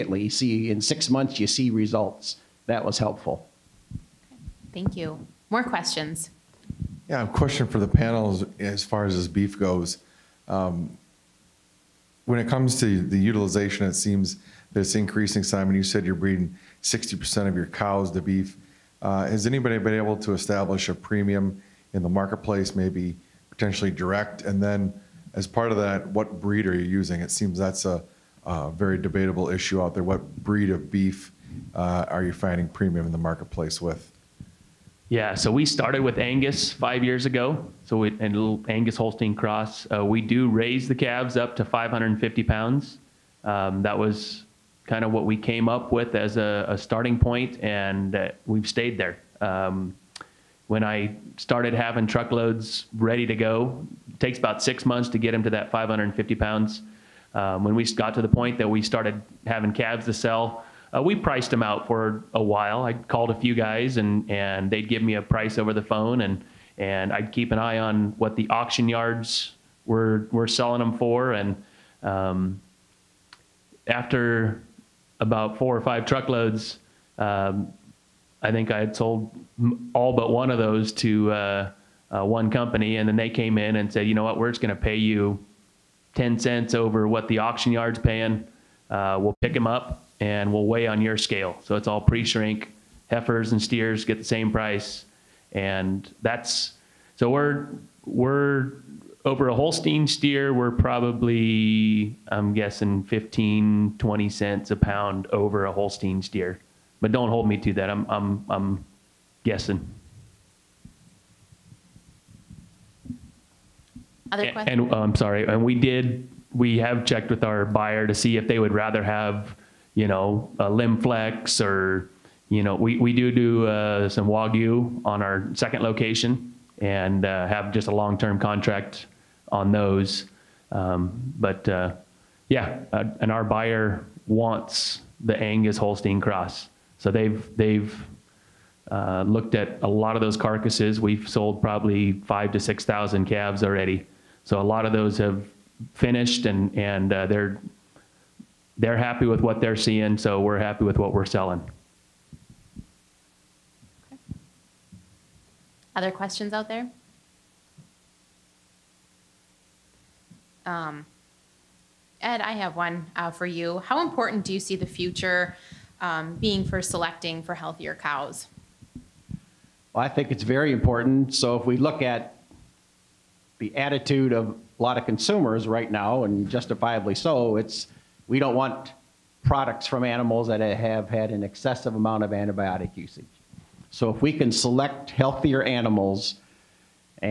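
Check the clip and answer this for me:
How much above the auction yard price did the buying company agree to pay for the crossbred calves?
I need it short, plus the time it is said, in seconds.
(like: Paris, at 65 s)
10 cents, at 86 s.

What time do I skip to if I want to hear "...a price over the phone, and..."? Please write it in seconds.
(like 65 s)
65 s.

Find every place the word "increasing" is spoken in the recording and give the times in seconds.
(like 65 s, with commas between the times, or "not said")
14 s.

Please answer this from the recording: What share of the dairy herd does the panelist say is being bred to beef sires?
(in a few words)
60%.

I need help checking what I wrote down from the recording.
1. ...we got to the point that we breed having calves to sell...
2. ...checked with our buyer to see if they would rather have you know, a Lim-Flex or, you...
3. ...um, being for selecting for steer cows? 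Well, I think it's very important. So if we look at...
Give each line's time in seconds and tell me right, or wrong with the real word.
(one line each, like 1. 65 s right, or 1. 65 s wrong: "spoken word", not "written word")
1. 57 s wrong: "started", not "breed"
2. 117 s right
3. 165 s wrong: "healthier", not "steer".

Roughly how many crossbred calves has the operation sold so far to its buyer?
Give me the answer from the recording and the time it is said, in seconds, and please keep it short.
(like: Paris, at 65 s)
5,000 to 6,000, at 142 s.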